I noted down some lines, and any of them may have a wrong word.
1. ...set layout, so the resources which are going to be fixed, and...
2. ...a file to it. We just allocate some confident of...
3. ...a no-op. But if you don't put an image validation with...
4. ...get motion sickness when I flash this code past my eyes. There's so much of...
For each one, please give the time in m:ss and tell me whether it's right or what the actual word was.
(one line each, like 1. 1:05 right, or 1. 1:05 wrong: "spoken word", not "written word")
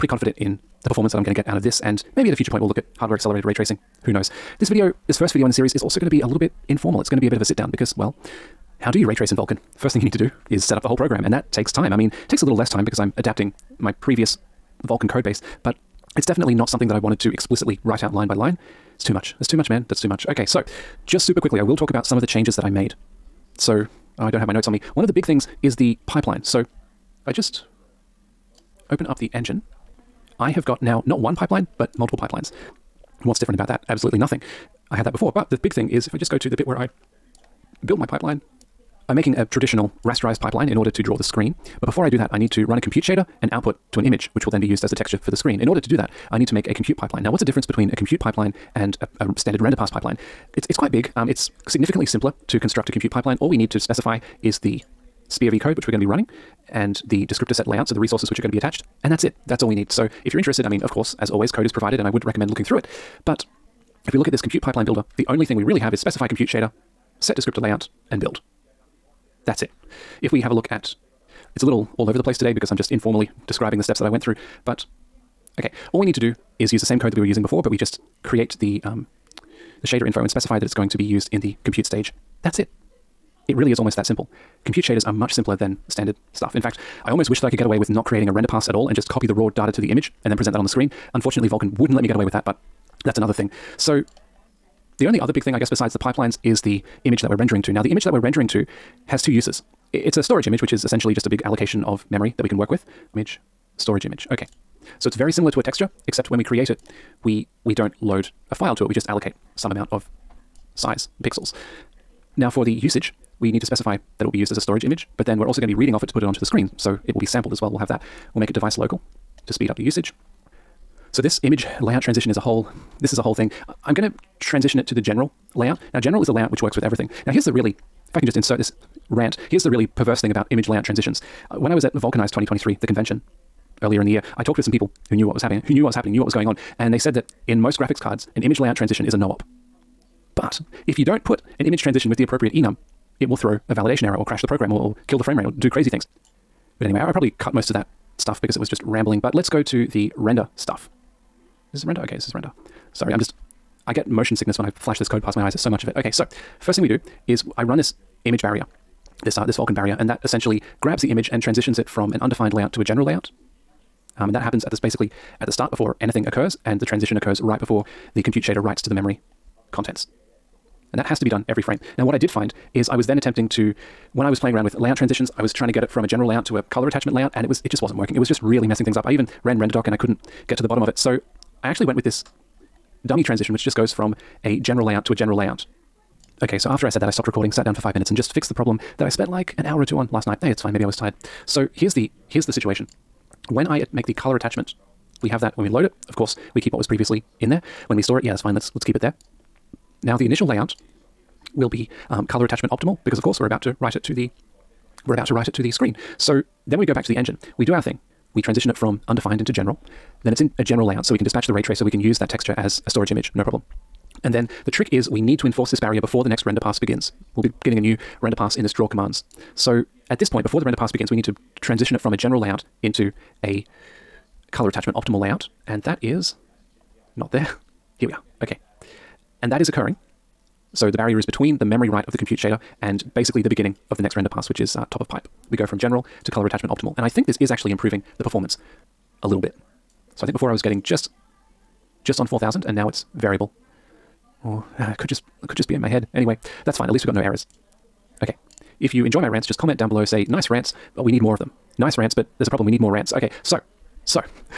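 1. 0:57 wrong: "attached", not "fixed"
2. 1:48 wrong: "amount", not "confident"
3. 2:19 wrong: "transition", not "validation"
4. 2:33 right.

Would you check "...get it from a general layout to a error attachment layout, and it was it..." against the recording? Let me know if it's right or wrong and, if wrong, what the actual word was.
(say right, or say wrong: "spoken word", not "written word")
wrong: "color", not "error".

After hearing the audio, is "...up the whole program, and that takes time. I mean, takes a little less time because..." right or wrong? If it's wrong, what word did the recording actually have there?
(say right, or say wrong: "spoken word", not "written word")
right.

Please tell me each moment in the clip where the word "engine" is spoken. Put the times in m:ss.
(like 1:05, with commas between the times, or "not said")
0:29, 3:27.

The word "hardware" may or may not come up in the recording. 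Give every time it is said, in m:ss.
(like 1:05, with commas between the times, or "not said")
0:02.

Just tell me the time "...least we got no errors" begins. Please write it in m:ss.
4:06.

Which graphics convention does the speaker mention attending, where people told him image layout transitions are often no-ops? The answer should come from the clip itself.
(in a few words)
Vulkanised 2023.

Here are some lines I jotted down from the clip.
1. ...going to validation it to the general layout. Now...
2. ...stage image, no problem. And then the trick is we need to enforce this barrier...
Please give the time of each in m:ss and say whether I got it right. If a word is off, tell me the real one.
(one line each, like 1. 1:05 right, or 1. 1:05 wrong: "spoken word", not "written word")
1. 2:03 wrong: "transition", not "validation"
2. 3:32 wrong: "storage", not "stage".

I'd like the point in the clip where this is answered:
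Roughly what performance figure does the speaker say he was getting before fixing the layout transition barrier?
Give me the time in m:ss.
4:02.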